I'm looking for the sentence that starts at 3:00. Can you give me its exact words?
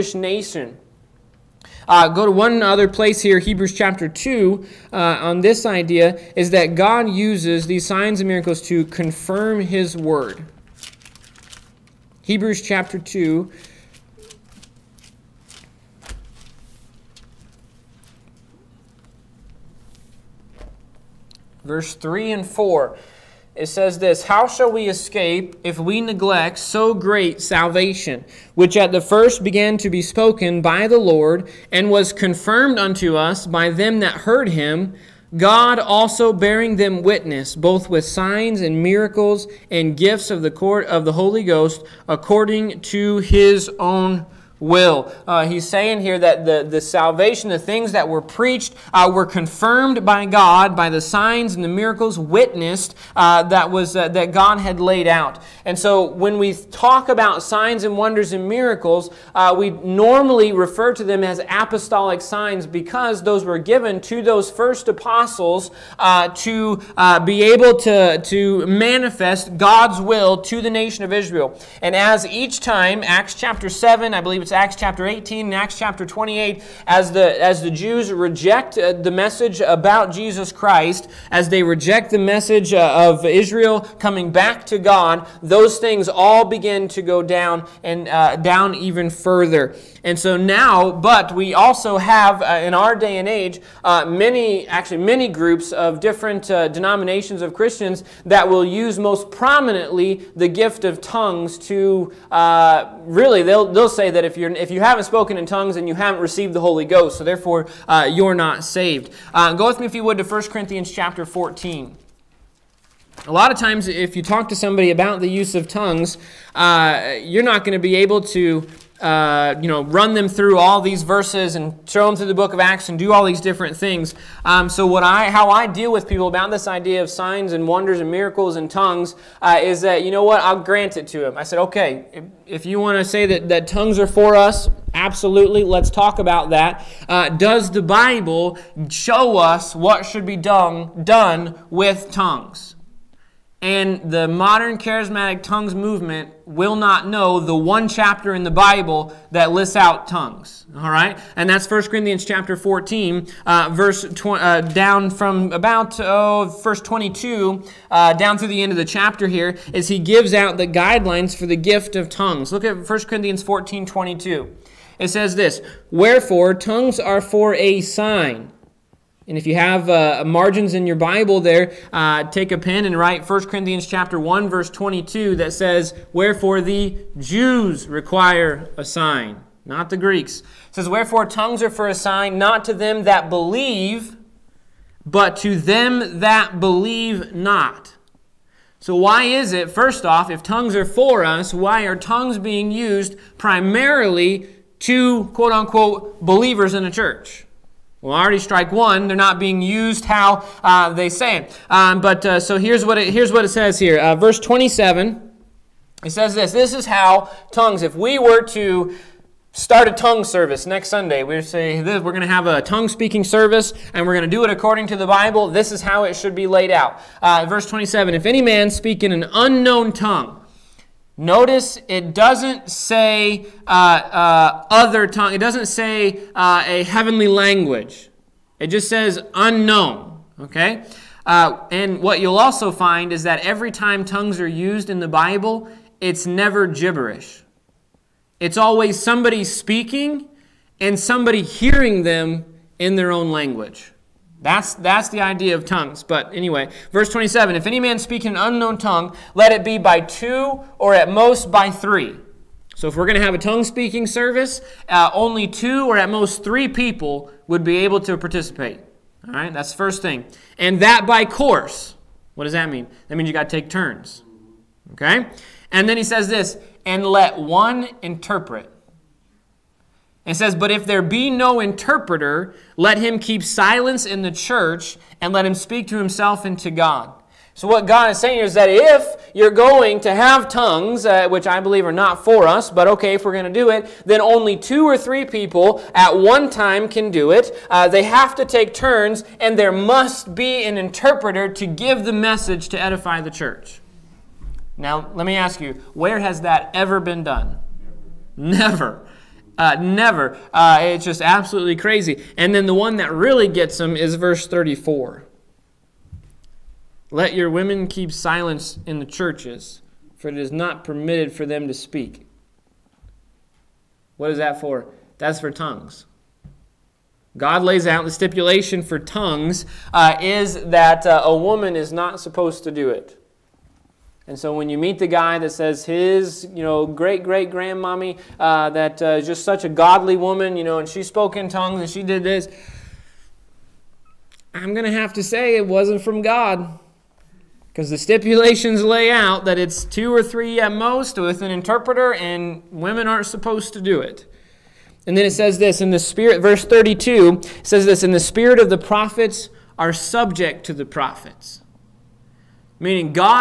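It says, Wherefore tongues are for a sign, not to them that believe, but to them that believe not.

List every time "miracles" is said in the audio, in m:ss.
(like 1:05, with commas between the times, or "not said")
0:08, 0:38, 0:51, 0:58, 2:08.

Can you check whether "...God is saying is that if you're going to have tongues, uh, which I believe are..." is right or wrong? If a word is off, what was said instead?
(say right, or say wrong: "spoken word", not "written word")
right.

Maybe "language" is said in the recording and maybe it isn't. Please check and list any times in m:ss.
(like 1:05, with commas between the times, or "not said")
3:47, 4:03.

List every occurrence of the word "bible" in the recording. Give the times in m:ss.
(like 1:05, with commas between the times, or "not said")
2:17, 2:28, 2:50, 3:35, 3:55.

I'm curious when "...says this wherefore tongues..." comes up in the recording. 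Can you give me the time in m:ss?
2:45.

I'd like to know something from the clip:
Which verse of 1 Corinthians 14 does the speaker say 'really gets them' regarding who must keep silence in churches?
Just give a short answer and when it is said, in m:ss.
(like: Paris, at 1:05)
Verse 34, at 5:04.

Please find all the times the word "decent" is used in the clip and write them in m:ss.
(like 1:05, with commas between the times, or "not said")
not said.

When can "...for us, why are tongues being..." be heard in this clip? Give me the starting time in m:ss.
3:10.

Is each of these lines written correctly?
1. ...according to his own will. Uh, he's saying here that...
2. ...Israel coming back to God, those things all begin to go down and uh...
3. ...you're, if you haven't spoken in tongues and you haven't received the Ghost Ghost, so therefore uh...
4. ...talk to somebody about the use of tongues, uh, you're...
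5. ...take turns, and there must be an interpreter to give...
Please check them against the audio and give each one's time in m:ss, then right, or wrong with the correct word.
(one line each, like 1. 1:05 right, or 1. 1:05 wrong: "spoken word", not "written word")
1. 0:42 right
2. 1:23 right
3. 1:44 wrong: "Holy", not "Ghost"
4. 1:54 right
5. 4:48 right.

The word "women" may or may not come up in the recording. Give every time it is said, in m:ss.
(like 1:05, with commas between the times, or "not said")
5:07, 5:42.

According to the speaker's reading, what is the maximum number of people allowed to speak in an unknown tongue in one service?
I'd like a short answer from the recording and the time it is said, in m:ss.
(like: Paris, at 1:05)
3, at 4:10.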